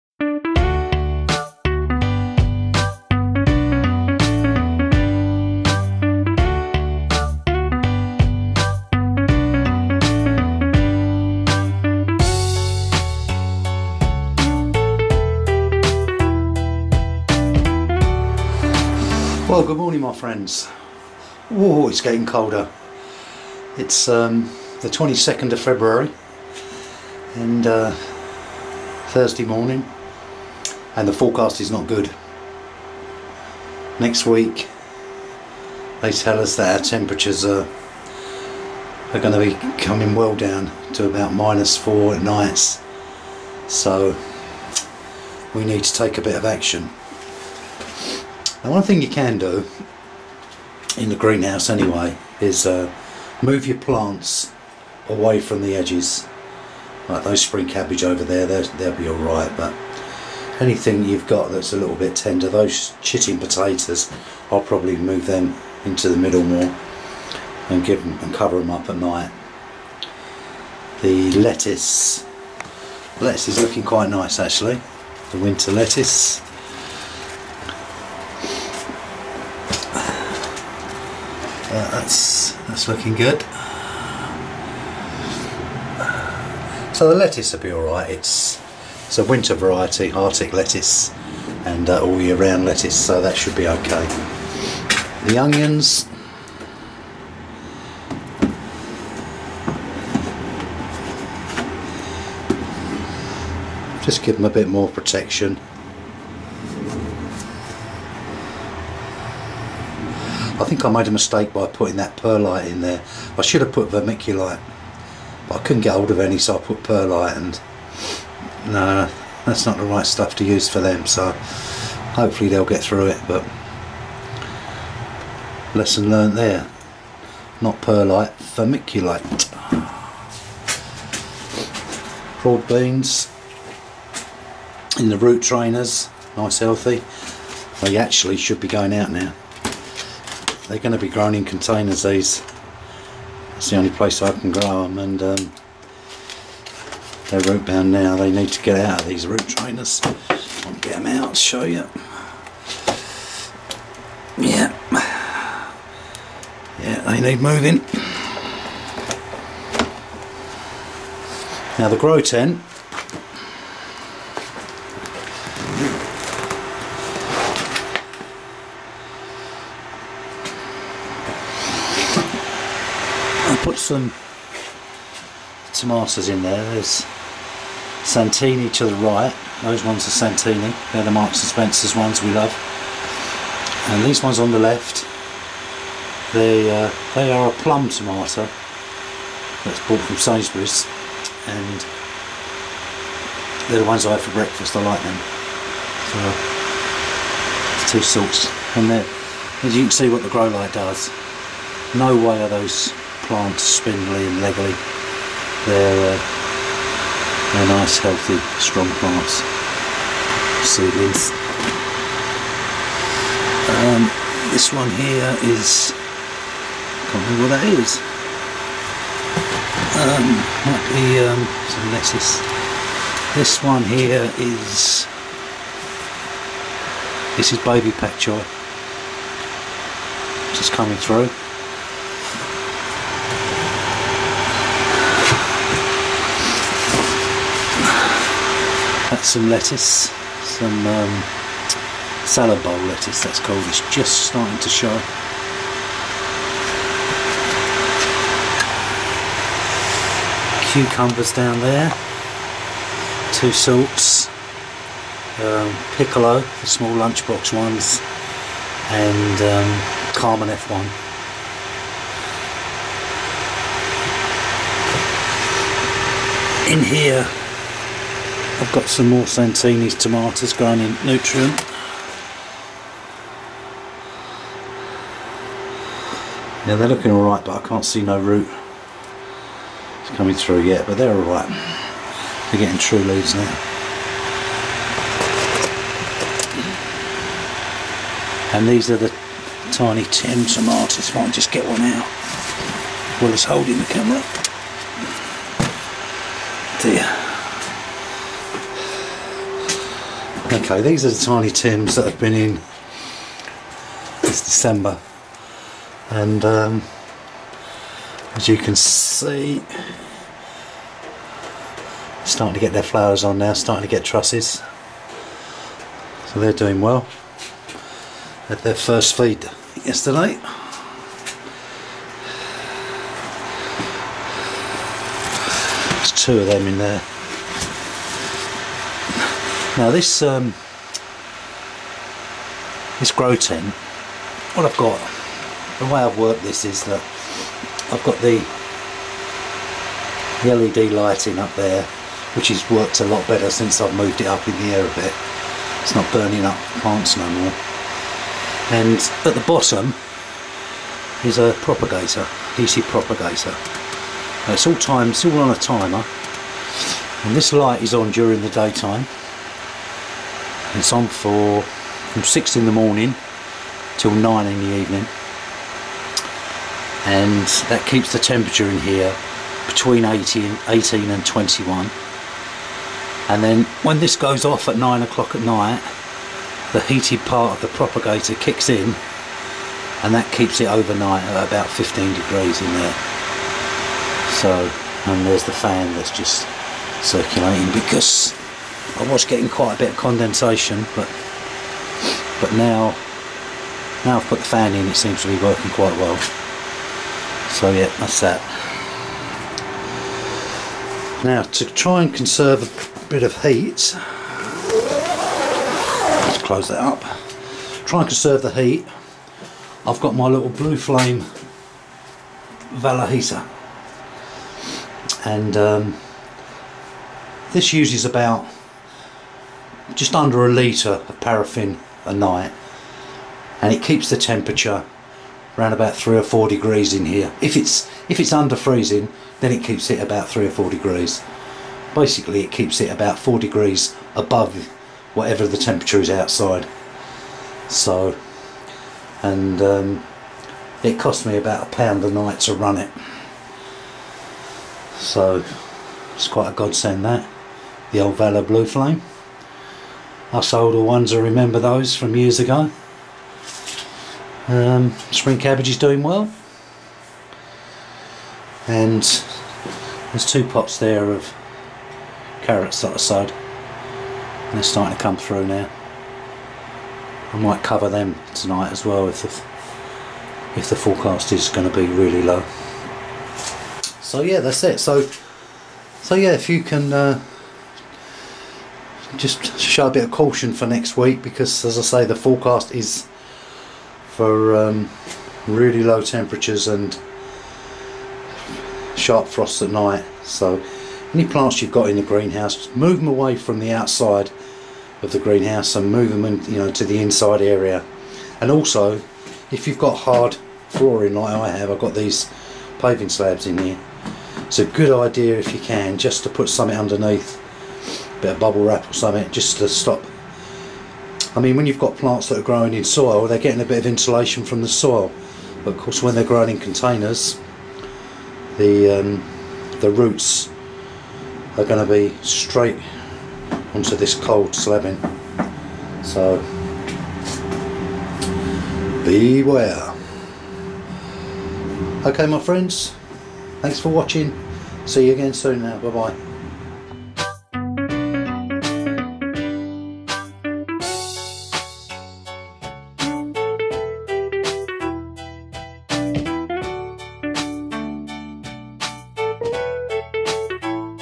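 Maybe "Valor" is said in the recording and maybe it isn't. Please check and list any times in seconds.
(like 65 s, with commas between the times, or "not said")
412 s, 448 s.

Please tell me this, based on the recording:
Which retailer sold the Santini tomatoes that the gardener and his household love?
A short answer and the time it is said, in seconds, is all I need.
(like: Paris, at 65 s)
Marks and Spencer's, at 181 s.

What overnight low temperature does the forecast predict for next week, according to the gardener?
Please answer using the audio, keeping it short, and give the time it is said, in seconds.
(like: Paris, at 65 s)
-4, at 41 s.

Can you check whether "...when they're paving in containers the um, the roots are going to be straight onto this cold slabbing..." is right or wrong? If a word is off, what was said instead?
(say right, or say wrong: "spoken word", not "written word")
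wrong: "growing", not "paving".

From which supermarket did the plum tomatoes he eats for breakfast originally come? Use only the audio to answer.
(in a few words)
Sainsbury's.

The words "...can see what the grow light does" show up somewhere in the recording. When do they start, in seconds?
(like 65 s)
199 s.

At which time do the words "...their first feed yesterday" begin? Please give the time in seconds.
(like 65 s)
318 s.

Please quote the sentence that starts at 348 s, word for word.
And at the bottom is a propagator, DC propagator.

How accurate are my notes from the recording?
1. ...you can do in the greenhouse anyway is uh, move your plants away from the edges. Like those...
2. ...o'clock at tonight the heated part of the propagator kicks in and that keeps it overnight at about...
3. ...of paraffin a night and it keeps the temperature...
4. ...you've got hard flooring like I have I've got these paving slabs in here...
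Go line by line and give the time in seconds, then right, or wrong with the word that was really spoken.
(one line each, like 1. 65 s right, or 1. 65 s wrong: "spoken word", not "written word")
1. 49 s right
2. 375 s wrong: "night", not "tonight"
3. 421 s right
4. 499 s right.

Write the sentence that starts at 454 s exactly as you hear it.
Um, spring cabbage is doing well.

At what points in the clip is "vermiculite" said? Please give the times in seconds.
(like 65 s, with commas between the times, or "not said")
113 s, 128 s.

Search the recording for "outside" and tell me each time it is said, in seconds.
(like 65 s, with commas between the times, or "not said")
436 s, 493 s.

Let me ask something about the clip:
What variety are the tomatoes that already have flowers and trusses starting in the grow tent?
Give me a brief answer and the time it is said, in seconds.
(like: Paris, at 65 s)
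Tiny Tim, at 301 s.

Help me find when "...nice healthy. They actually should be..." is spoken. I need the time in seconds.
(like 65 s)
136 s.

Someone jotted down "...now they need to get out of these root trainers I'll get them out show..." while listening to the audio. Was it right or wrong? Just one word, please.
right.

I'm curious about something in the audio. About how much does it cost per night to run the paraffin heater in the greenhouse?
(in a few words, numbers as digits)
a pound.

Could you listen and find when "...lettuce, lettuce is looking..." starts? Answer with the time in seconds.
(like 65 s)
71 s.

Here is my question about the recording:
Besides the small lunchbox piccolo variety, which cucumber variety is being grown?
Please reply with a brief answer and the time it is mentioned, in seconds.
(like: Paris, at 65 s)
Carmen F1, at 260 s.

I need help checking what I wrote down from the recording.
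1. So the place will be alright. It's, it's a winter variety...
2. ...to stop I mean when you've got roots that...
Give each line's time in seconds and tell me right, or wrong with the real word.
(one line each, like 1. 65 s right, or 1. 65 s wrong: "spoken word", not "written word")
1. 86 s wrong: "lettuce", not "place"
2. 509 s wrong: "plants", not "roots".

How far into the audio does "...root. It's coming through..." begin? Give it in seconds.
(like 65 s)
278 s.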